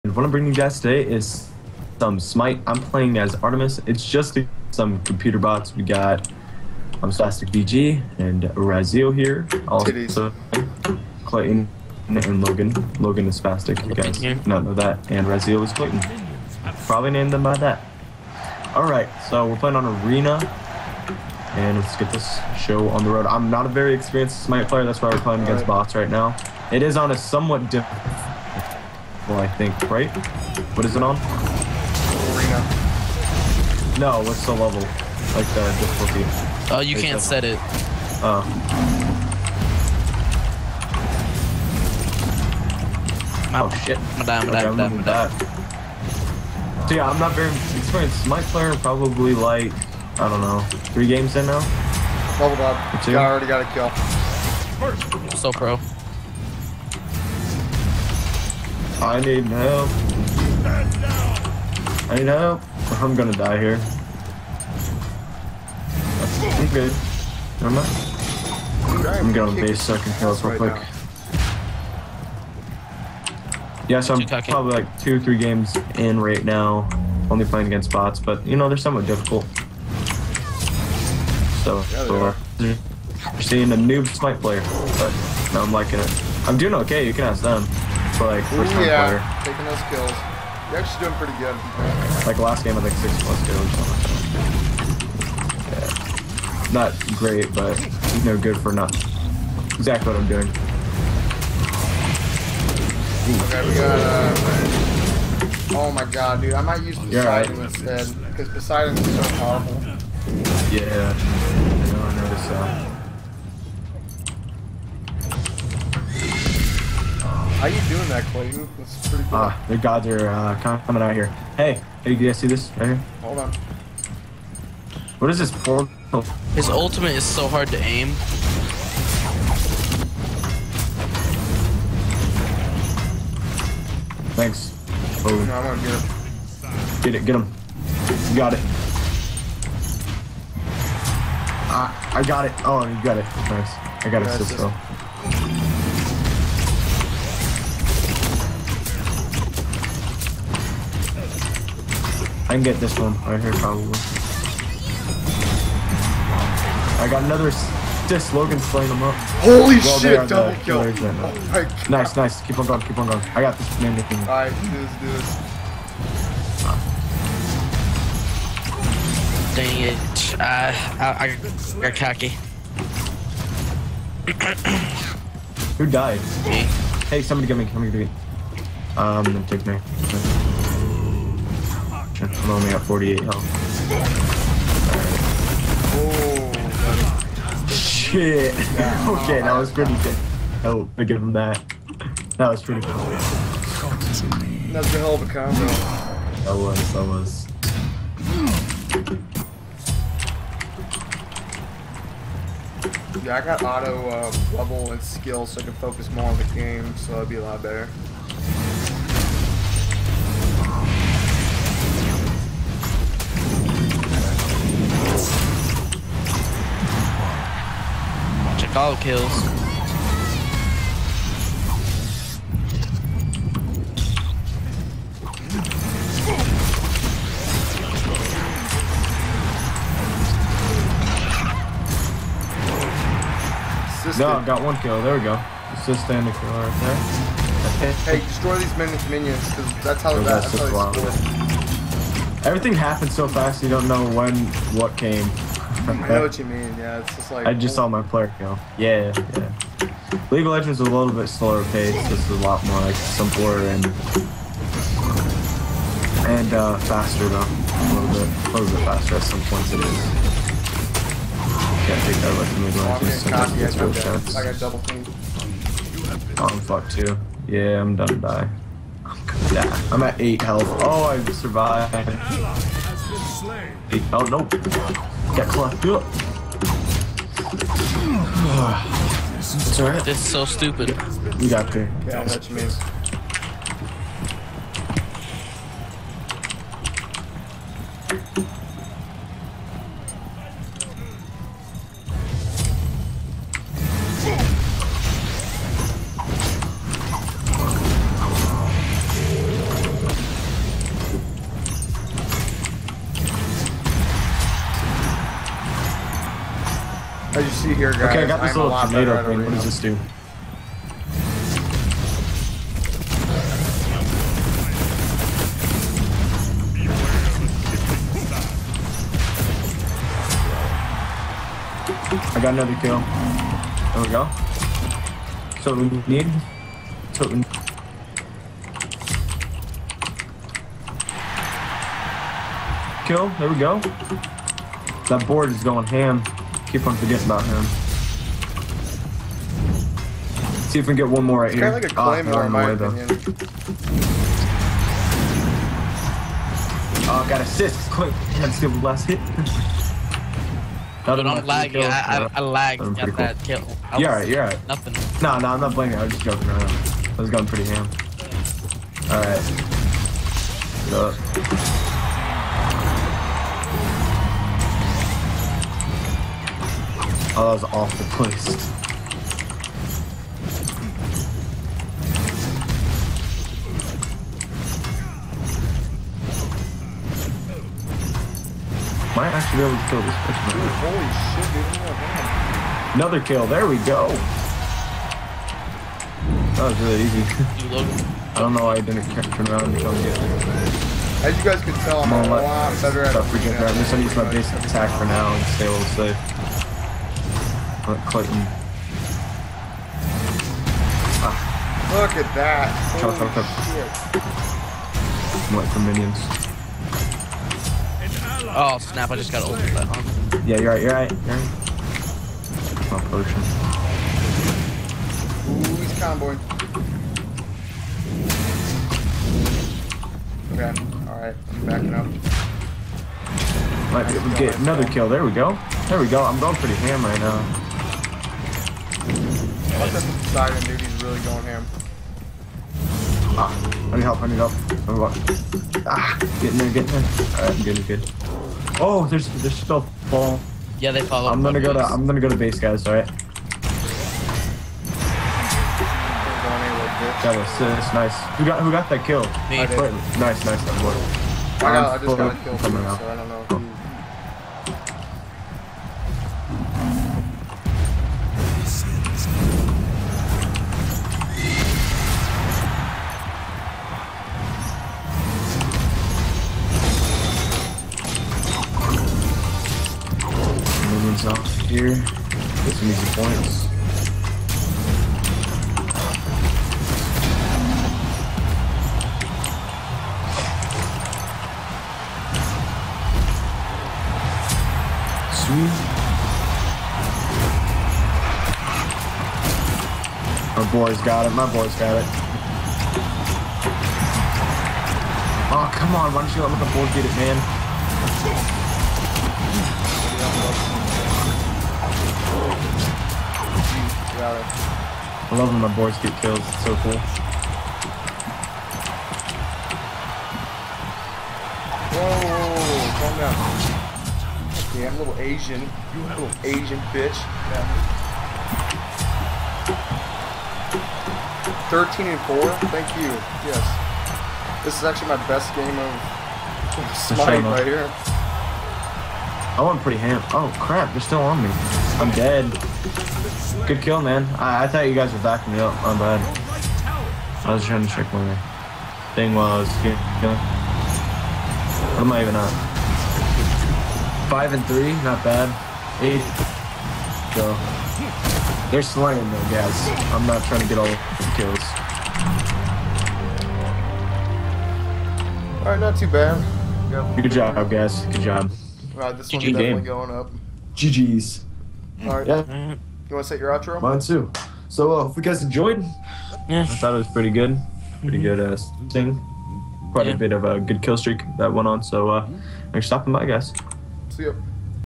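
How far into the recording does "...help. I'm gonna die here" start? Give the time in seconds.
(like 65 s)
62 s.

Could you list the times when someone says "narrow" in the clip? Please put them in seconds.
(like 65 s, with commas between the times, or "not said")
not said.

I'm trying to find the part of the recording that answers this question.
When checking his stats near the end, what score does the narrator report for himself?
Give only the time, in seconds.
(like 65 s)
544 s.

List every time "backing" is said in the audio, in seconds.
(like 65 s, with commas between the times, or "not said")
421 s, 535 s.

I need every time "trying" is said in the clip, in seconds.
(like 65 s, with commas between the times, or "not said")
537 s, 550 s.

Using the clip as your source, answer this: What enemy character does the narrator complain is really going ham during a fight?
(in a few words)
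siren.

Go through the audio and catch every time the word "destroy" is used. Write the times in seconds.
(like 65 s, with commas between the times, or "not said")
238 s.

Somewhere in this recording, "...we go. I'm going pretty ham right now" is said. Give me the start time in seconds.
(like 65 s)
425 s.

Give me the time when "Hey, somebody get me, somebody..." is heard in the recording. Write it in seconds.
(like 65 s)
177 s.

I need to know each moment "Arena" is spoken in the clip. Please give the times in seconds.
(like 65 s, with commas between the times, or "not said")
20 s, 32 s.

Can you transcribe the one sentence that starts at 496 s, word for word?
Why don't you let the board get it, man?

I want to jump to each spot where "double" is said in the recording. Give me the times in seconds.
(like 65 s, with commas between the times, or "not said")
160 s, 264 s.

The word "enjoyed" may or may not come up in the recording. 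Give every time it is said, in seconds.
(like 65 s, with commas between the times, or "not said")
565 s.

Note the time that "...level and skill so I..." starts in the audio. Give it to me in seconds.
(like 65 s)
204 s.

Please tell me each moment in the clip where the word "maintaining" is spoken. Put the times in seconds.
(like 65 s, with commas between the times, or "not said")
not said.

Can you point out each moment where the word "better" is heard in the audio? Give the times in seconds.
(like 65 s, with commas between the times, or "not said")
207 s, 392 s.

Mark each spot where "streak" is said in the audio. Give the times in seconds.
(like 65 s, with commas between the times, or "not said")
570 s.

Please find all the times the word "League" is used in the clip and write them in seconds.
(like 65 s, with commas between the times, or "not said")
250 s, 262 s.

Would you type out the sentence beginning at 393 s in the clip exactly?
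I'm just gonna use my base attack for now and stay a little safe.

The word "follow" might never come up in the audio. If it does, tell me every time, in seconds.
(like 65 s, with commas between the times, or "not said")
441 s.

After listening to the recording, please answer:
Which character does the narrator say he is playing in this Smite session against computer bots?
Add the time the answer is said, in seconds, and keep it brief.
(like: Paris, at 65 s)
Artemis, at 3 s.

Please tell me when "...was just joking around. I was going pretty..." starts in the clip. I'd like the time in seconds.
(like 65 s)
356 s.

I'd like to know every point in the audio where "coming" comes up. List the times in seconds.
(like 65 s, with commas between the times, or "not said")
120 s.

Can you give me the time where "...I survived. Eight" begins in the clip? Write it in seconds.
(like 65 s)
271 s.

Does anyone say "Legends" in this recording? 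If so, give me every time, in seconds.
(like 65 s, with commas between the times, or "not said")
250 s, 262 s.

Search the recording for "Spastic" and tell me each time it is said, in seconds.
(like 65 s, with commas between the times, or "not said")
7 s, 13 s.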